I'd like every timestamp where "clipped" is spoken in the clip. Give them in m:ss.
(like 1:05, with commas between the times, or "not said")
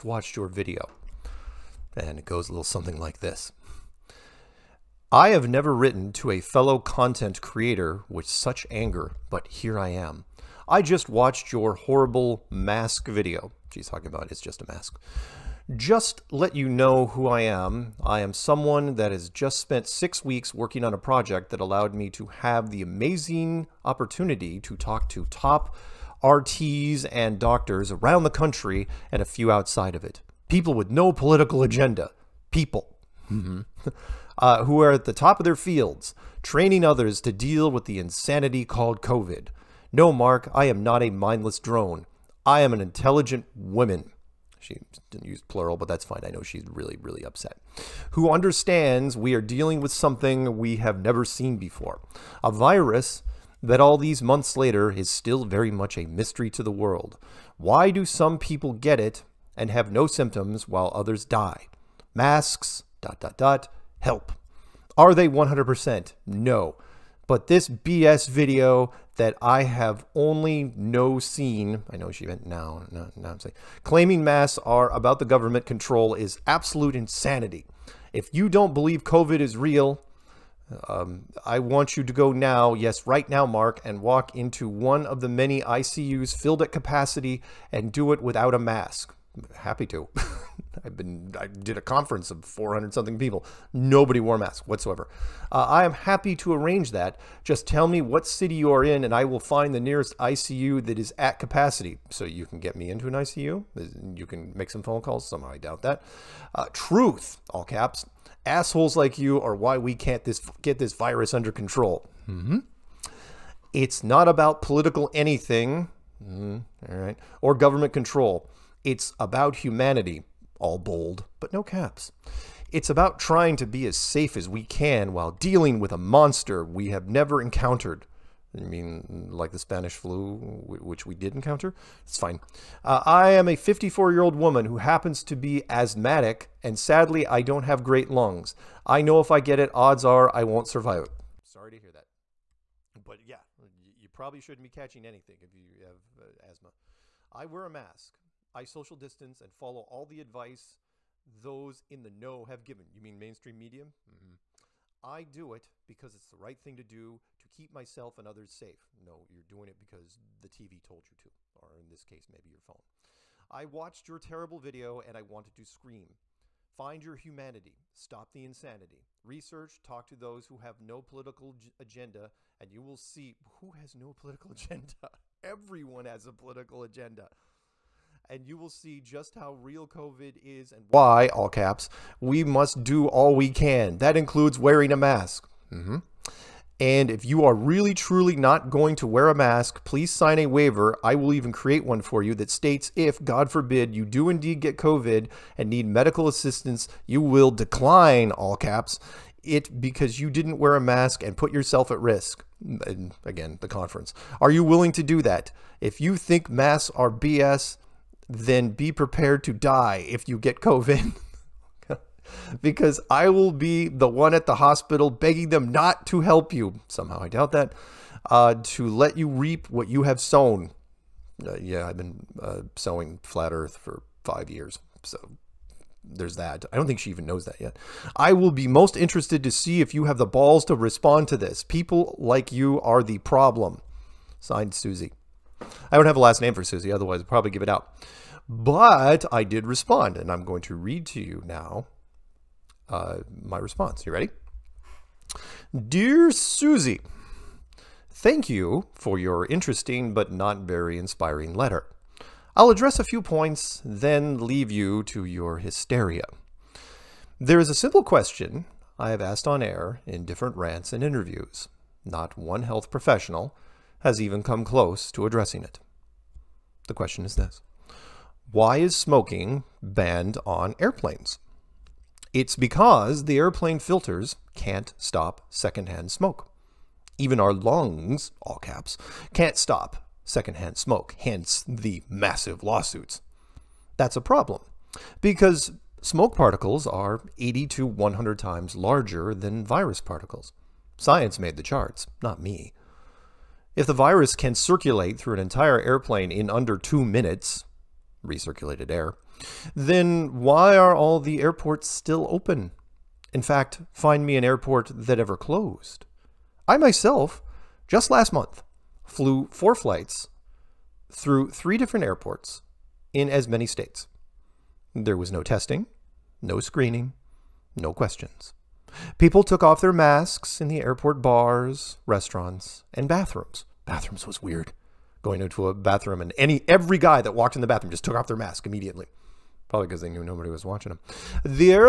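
not said.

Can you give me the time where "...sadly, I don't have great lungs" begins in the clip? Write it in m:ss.
2:16.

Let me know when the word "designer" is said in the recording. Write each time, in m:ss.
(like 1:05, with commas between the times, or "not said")
not said.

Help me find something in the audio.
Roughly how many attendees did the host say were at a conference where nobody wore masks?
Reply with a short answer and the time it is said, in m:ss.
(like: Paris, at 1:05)
400, at 1:32.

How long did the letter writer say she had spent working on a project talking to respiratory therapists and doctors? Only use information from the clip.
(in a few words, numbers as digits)
6 weeks.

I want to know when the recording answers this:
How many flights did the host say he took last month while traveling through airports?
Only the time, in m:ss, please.
5:09.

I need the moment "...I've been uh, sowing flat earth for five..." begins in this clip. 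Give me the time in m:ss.
3:41.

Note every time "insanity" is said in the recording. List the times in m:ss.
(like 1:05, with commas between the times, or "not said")
0:37, 1:16, 2:48.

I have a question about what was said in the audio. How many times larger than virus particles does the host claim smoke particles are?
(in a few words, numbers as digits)
80 to 100 times.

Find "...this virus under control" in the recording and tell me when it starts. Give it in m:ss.
1:50.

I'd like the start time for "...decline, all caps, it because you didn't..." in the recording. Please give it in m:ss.
3:17.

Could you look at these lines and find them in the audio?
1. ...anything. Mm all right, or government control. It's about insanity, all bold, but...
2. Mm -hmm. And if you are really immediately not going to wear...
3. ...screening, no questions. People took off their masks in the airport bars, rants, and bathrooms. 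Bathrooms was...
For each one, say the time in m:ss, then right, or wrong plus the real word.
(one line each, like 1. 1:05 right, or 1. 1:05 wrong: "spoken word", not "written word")
1. 1:55 wrong: "humanity", not "insanity"
2. 3:05 wrong: "truly", not "immediately"
3. 5:16 wrong: "restaurants", not "rants".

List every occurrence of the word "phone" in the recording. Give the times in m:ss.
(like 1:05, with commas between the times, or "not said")
1:44, 2:42.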